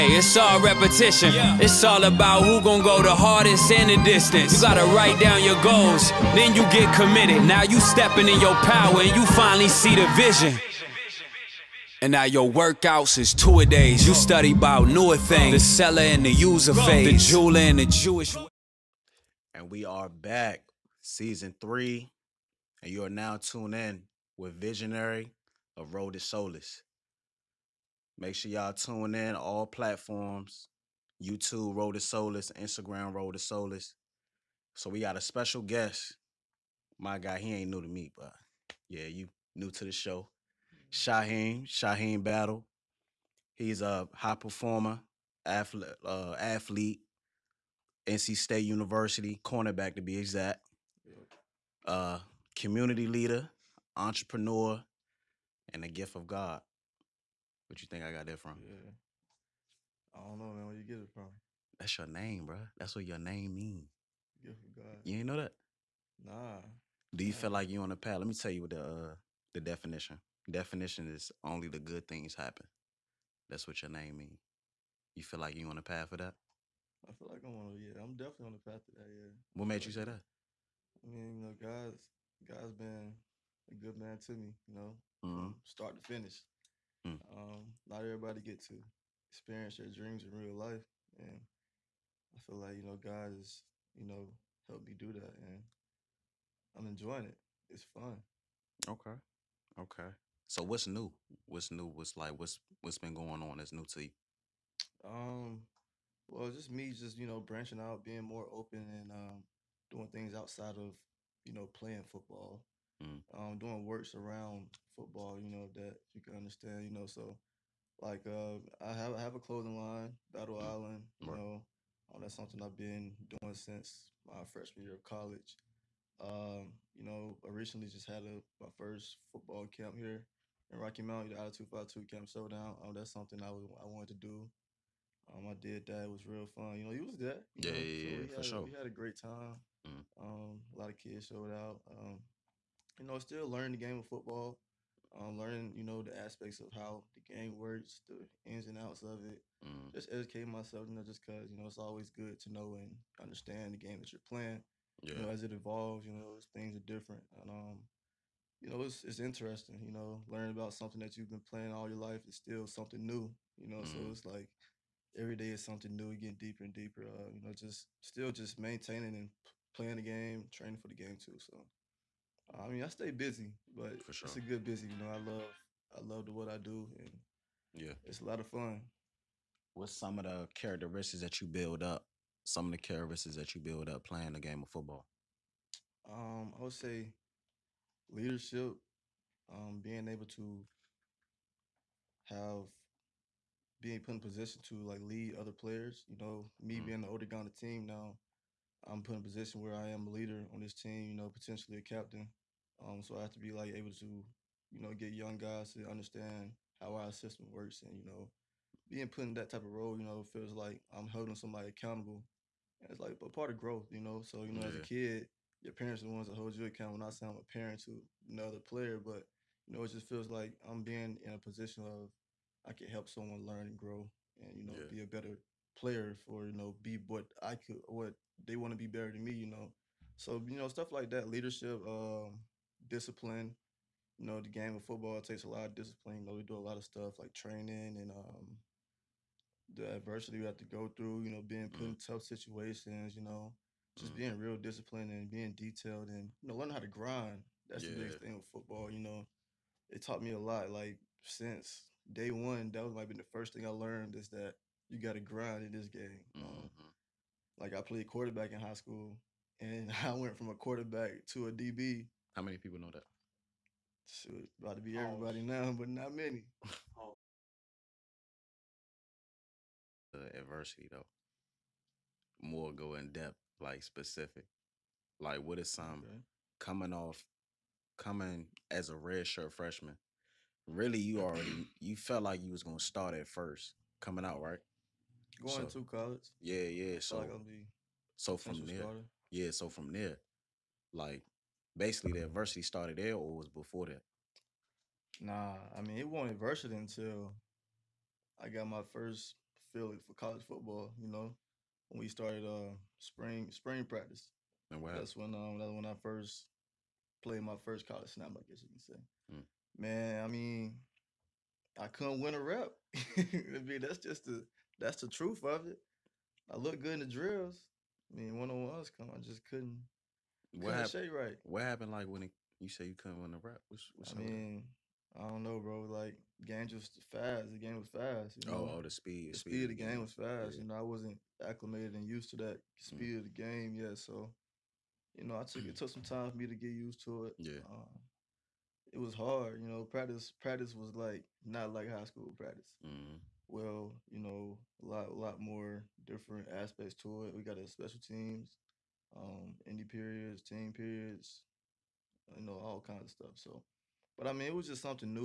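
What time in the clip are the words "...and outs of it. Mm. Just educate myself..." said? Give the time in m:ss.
2:28.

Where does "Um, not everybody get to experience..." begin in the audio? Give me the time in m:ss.
1:27.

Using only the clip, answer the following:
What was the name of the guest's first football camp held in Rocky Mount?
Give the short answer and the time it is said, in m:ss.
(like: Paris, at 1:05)
Attitude 52 Camp Showdown, at 2:11.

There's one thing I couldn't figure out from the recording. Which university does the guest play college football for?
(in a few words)
NC State University.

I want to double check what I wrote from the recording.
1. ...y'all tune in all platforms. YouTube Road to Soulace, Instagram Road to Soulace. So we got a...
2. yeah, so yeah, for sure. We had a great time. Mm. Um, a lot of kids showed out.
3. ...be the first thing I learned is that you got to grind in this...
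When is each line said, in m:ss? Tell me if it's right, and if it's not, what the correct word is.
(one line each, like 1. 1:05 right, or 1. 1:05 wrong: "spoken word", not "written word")
1. 0:28 right
2. 2:17 right
3. 4:13 right.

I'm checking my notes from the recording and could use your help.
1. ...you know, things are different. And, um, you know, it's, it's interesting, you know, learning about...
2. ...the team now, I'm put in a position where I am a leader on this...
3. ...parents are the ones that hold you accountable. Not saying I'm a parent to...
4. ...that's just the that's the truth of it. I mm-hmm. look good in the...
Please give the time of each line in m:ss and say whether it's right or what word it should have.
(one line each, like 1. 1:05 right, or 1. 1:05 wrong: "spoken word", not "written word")
1. 2:36 right
2. 3:17 right
3. 3:35 right
4. 5:13 right.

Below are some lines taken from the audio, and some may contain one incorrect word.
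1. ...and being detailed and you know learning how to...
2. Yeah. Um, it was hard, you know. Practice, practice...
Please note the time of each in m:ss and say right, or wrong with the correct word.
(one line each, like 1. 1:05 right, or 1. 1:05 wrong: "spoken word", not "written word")
1. 4:05 right
2. 5:37 right.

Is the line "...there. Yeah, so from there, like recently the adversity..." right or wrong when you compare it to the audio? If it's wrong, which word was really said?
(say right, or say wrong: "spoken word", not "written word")
wrong: "basically", not "recently".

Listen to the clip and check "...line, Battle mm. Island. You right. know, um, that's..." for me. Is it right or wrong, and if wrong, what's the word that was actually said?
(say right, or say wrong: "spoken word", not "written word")
right.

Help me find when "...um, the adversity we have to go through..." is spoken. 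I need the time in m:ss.
3:58.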